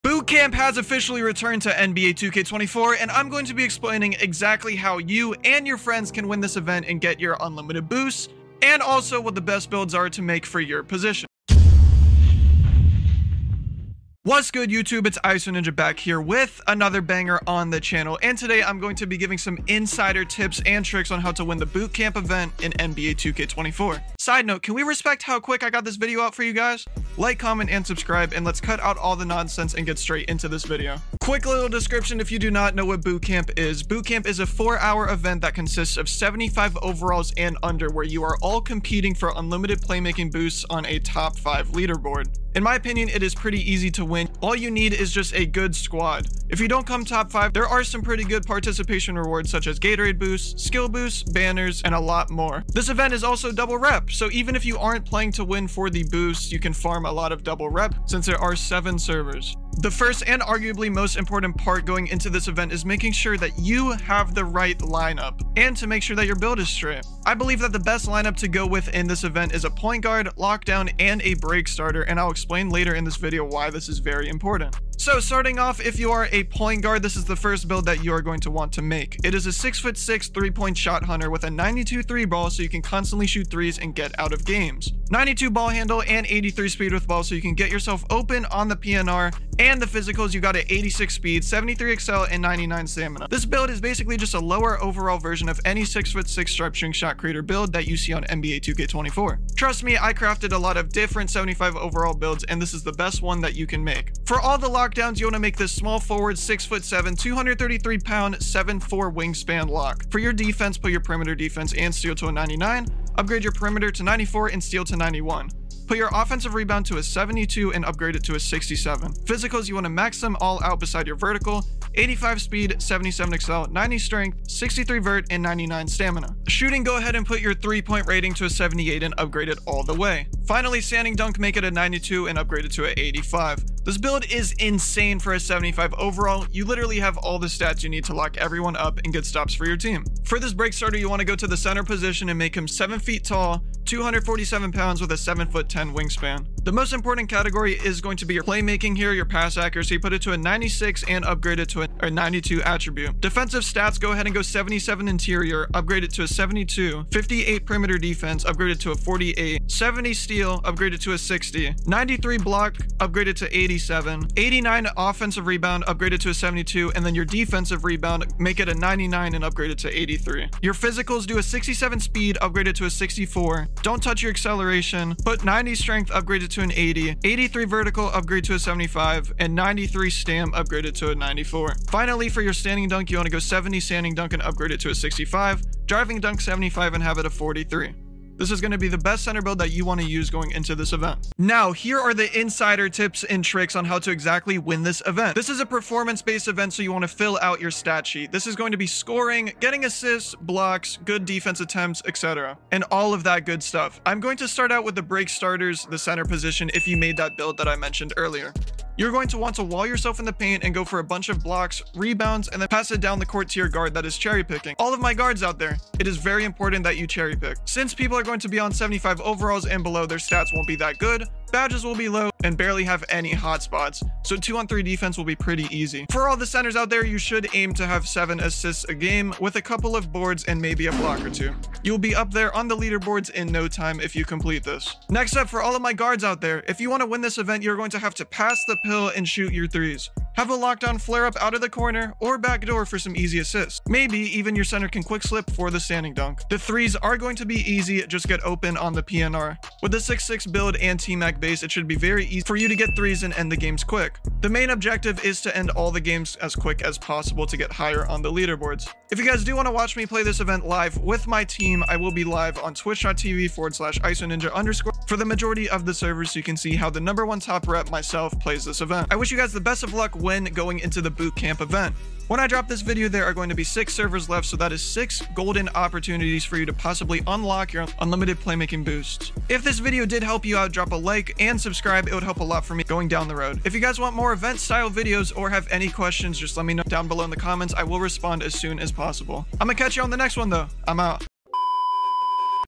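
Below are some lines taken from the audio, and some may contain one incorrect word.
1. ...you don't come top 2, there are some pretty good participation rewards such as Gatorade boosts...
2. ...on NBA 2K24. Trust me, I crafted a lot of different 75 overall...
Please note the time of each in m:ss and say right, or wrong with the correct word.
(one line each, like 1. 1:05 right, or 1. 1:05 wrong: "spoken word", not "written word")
1. 0:46 wrong: "5", not "2"
2. 1:38 right.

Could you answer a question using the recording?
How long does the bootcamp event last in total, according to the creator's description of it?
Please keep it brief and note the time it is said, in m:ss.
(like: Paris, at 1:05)
4 hours, at 0:34.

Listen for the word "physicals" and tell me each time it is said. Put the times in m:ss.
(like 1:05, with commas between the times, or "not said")
1:29, 1:59, 2:50.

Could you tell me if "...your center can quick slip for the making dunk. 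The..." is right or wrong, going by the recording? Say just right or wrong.
wrong.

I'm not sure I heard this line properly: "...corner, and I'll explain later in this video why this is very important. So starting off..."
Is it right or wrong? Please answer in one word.
wrong.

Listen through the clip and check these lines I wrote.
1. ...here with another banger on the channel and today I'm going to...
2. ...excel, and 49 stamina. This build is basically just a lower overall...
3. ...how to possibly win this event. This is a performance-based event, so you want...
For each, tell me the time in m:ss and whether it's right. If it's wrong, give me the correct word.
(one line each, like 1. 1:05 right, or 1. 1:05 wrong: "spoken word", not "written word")
1. 0:15 right
2. 1:31 wrong: "99", not "49"
3. 3:13 wrong: "exactly", not "possibly".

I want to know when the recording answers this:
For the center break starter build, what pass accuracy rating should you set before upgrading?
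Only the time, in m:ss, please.
2:30.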